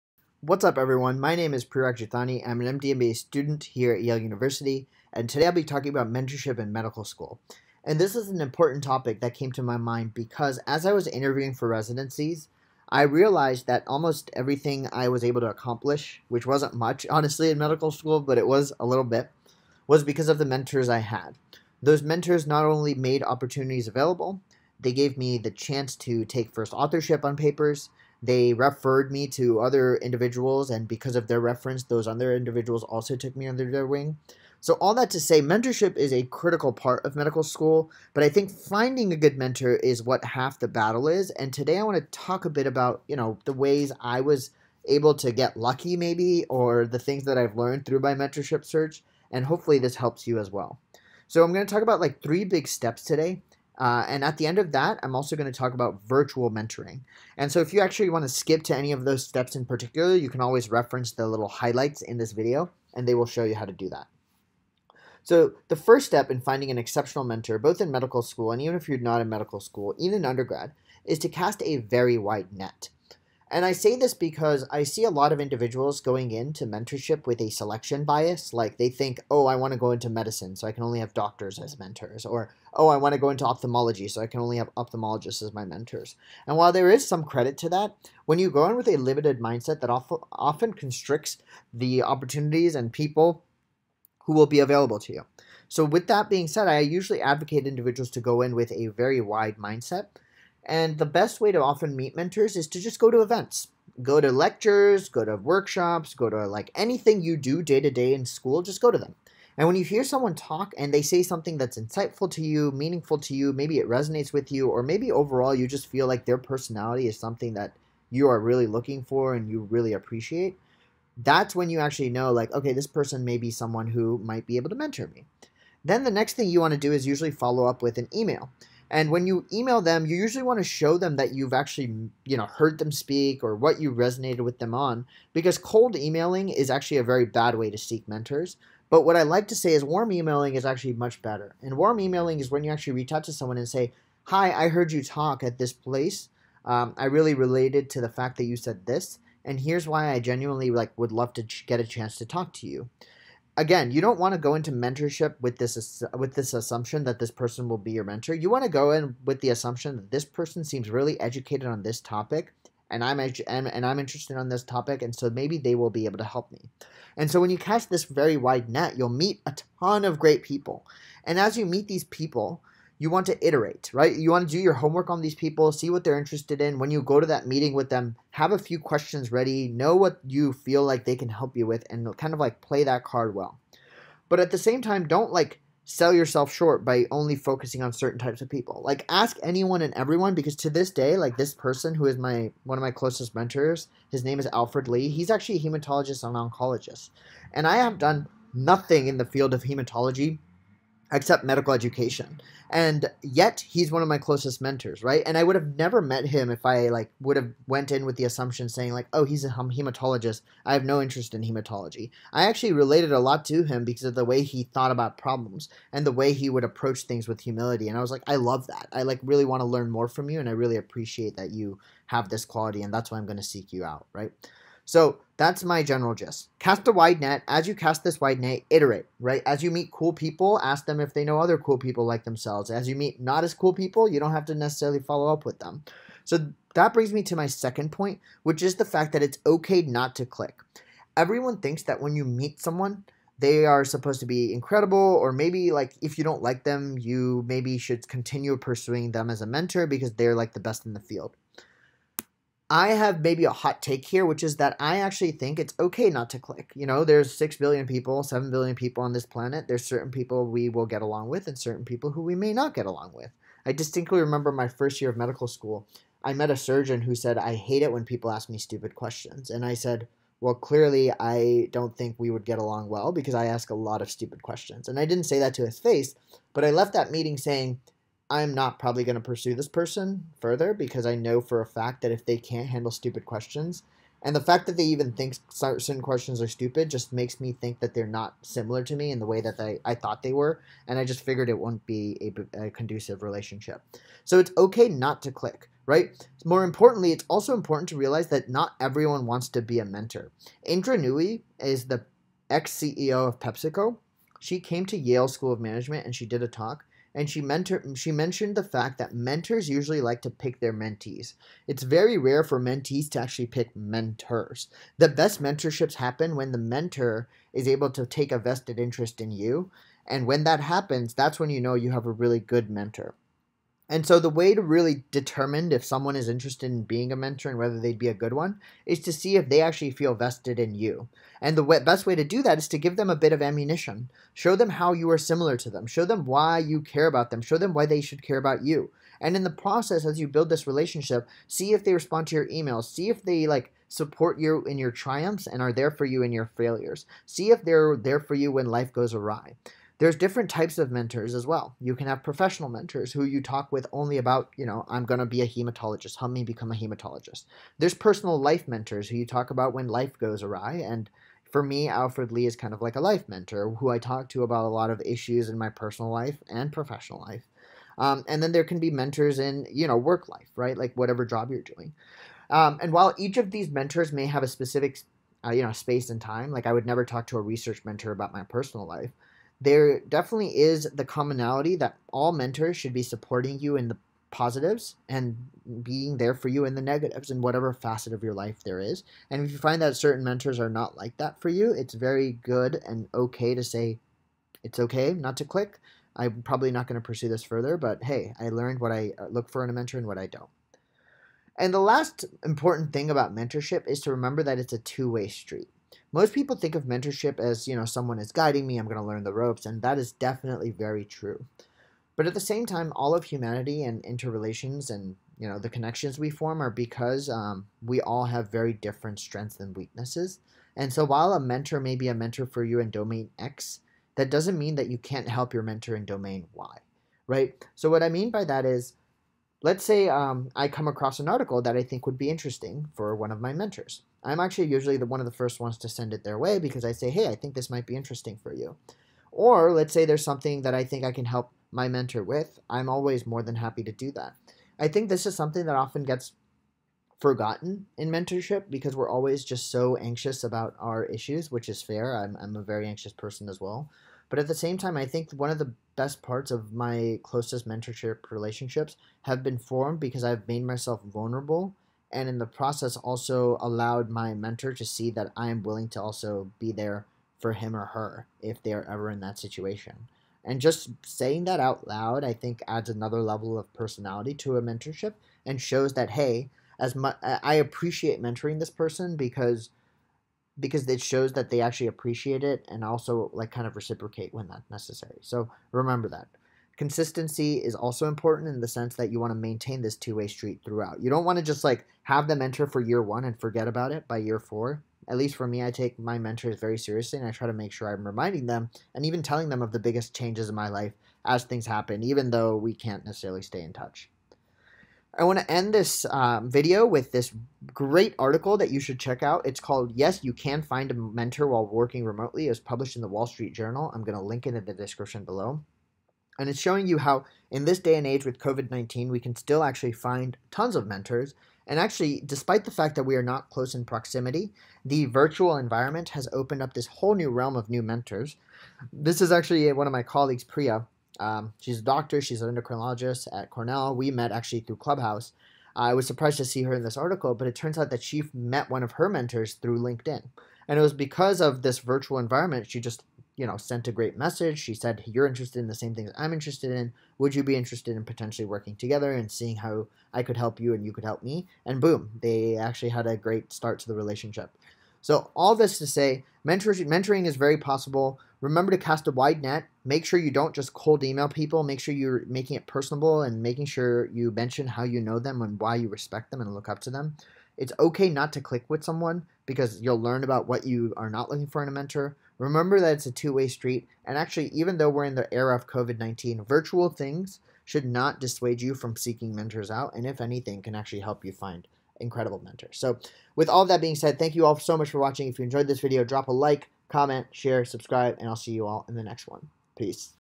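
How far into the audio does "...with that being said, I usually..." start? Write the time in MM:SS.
01:35.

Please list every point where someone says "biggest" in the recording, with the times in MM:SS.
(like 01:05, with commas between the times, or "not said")
08:19.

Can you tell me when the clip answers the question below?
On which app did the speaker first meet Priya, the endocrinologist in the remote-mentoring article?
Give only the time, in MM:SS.
08:54.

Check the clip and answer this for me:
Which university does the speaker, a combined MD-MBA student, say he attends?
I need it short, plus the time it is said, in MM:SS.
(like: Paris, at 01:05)
Yale University, at 00:04.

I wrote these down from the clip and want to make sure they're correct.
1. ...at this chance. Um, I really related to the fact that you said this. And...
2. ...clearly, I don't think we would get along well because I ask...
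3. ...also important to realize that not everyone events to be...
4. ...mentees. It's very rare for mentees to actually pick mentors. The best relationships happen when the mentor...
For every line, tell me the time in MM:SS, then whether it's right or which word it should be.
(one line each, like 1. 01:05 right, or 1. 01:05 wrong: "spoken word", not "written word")
1. 02:25 wrong: "place", not "chance"
2. 04:30 right
3. 04:57 wrong: "wants", not "events"
4. 05:10 wrong: "mentorships", not "relationships".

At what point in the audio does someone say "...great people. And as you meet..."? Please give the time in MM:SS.
02:50.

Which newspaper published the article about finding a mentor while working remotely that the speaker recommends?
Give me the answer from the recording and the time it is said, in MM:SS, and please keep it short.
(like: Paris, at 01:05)
Wall Street Journal, at 08:33.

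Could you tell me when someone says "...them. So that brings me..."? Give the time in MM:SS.
03:55.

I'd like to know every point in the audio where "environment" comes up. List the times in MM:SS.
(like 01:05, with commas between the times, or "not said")
08:45, 09:02.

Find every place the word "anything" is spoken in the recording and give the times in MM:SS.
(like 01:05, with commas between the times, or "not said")
01:46, 09:40.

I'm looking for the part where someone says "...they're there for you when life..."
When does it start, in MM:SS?
05:47.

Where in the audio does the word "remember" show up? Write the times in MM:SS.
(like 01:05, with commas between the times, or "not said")
04:24, 06:44, 08:05, 09:18, 09:32.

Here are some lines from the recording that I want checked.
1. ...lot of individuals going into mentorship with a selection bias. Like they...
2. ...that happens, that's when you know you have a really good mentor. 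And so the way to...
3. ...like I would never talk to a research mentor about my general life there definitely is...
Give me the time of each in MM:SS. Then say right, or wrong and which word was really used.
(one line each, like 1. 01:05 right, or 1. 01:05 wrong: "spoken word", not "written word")
1. 01:15 right
2. 05:20 right
3. 06:16 wrong: "personal", not "general".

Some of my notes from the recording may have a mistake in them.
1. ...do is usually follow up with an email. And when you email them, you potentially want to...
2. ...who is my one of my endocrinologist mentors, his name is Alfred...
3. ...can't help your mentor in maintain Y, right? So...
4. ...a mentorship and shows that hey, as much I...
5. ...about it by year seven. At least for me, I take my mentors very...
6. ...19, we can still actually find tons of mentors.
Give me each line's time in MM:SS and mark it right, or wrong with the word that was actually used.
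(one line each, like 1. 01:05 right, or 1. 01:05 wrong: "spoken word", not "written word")
1. 02:06 wrong: "usually", not "potentially"
2. 03:11 wrong: "closest", not "endocrinologist"
3. 07:04 wrong: "domain", not "maintain"
4. 07:54 right
5. 08:13 wrong: "four", not "seven"
6. 08:38 right.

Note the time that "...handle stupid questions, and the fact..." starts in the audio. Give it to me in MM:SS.
04:42.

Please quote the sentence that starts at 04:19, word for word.
There's certain people we will get along with and certain people who we may not get along with.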